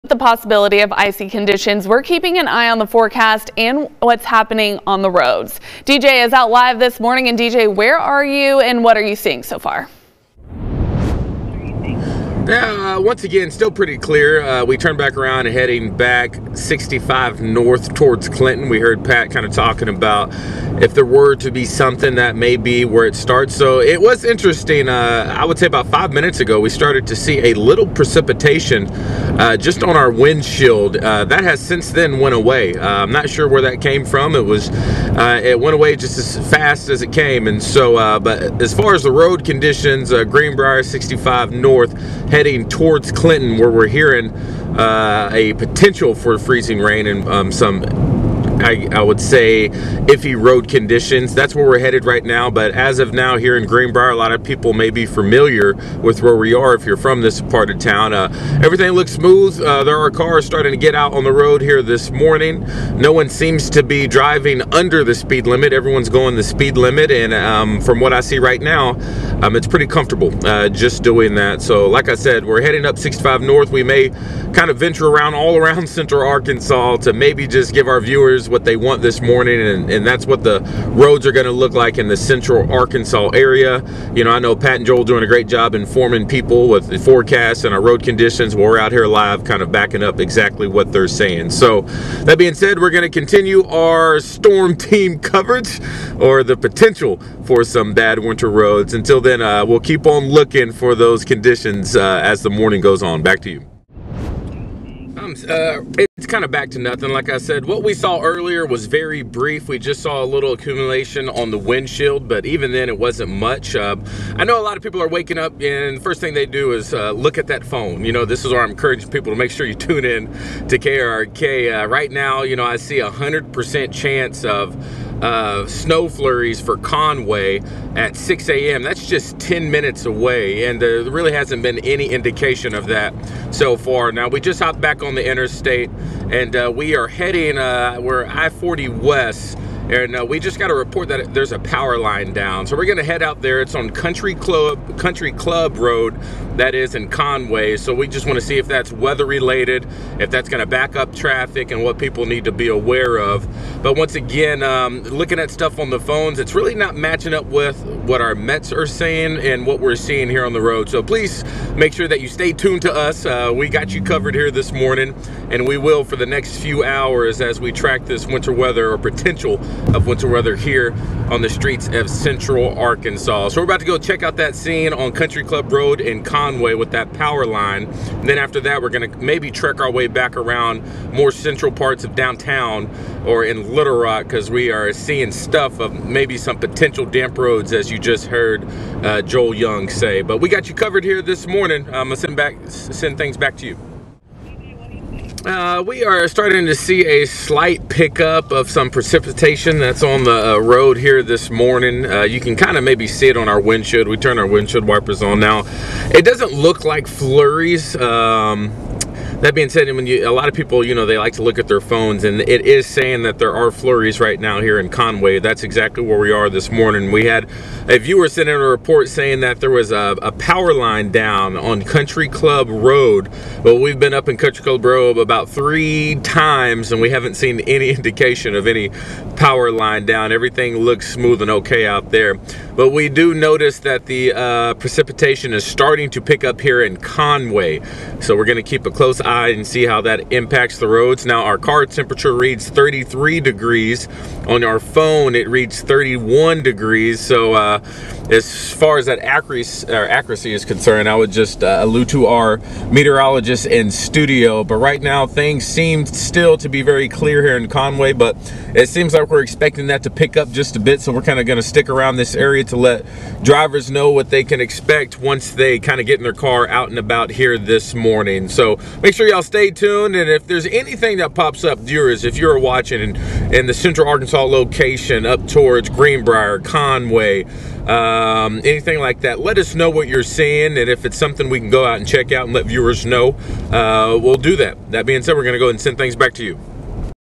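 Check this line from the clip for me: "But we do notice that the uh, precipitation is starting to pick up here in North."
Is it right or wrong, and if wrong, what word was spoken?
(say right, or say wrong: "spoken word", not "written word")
wrong: "Conway", not "North".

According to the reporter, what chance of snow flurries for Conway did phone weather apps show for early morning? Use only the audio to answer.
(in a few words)
100%.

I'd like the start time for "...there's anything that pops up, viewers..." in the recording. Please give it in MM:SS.
04:30.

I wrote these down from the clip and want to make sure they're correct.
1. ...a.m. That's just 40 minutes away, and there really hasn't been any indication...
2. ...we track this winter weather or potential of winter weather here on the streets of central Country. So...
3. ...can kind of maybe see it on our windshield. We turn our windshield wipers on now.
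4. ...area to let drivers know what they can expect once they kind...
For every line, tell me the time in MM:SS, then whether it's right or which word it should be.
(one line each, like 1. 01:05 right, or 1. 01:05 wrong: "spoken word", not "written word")
1. 02:08 wrong: "10", not "40"
2. 02:47 wrong: "Arkansas", not "Country"
3. 03:22 right
4. 04:22 right.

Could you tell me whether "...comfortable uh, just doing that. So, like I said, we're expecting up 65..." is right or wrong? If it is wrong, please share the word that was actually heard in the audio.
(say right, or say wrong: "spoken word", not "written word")
wrong: "heading", not "expecting".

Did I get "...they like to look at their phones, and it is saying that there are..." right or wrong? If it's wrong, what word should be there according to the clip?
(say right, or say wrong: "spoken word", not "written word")
right.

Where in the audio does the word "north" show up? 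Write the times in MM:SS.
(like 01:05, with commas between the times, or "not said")
00:17, 00:41, 01:13.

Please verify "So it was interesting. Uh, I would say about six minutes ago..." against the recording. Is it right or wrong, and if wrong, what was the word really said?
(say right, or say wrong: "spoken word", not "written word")
wrong: "five", not "six".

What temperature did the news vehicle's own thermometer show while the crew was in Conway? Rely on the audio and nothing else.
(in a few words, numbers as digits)
33 degrees.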